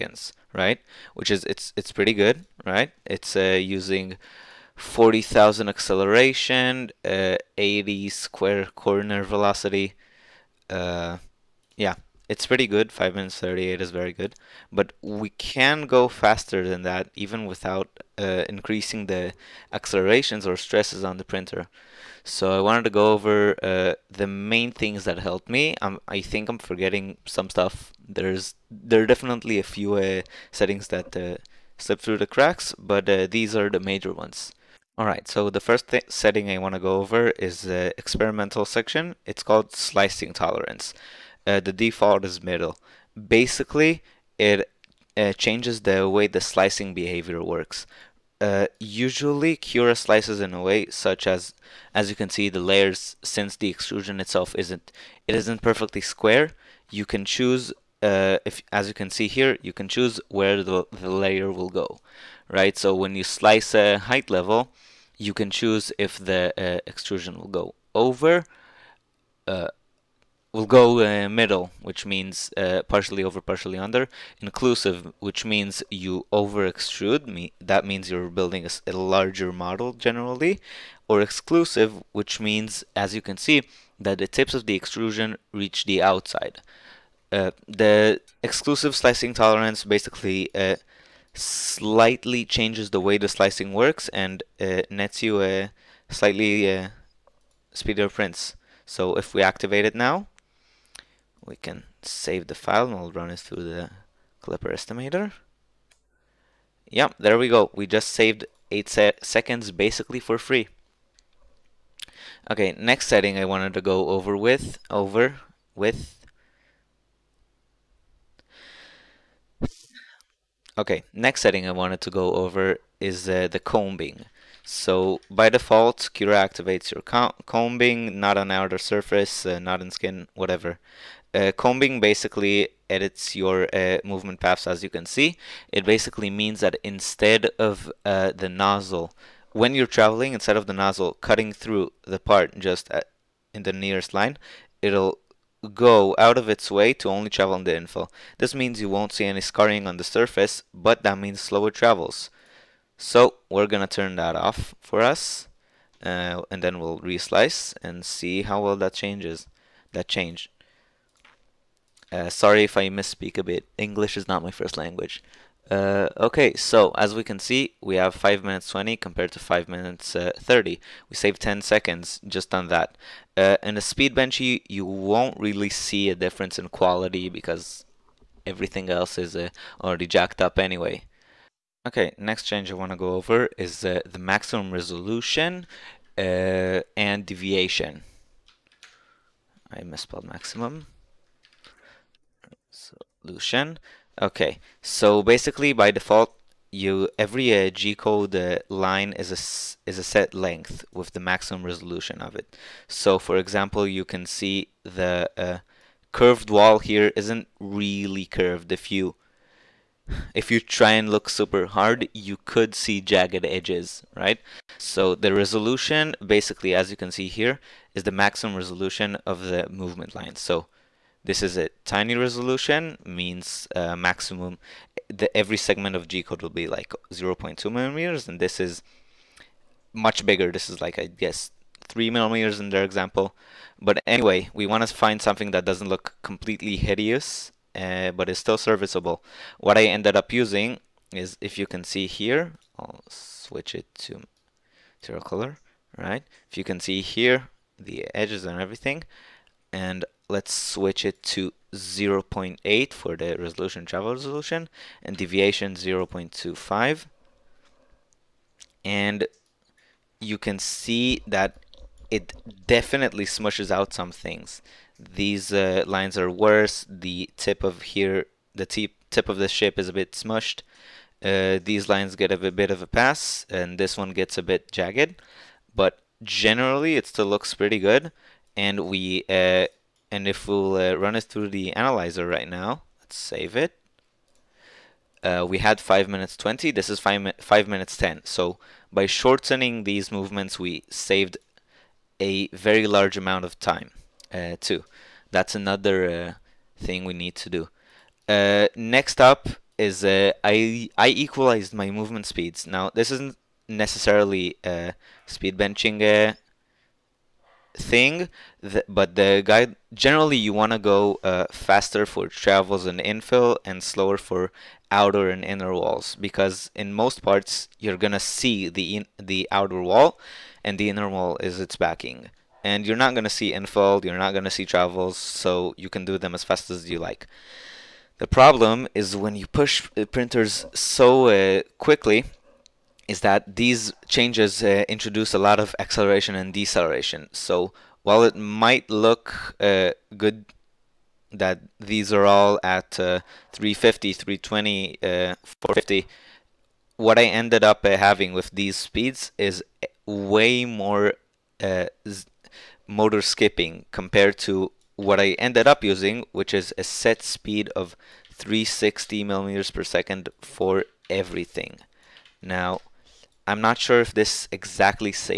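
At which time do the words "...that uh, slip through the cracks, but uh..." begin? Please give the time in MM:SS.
00:30.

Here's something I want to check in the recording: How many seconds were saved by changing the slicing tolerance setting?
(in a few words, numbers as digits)
8 seconds.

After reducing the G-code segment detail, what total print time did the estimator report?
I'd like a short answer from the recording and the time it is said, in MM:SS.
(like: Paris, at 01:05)
5 minutes 10, at 04:47.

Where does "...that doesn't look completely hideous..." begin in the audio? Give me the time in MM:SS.
03:55.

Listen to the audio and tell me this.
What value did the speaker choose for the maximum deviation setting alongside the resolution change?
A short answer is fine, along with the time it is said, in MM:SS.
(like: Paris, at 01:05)
0.25, at 04:15.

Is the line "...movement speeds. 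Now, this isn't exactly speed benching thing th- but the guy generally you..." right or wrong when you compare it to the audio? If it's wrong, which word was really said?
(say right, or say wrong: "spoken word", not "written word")
wrong: "necessarily", not "exactly".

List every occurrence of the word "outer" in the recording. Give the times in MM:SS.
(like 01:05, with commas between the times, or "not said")
02:08, 05:14, 05:19.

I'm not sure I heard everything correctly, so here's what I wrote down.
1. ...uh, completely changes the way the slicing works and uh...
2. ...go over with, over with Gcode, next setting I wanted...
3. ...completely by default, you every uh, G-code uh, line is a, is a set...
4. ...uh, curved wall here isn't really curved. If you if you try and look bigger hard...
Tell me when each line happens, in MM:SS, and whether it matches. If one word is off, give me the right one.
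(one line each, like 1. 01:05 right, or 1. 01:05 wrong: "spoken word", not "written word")
1. 01:30 wrong: "slightly", not "completely"
2. 01:53 wrong: "Okay", not "Gcode"
3. 03:15 wrong: "basically", not "completely"
4. 03:25 wrong: "super", not "bigger".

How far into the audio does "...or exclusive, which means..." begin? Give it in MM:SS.
01:21.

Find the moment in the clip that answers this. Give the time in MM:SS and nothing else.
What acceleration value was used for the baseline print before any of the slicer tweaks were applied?
00:04.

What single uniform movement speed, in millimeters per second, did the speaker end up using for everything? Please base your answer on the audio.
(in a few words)
360.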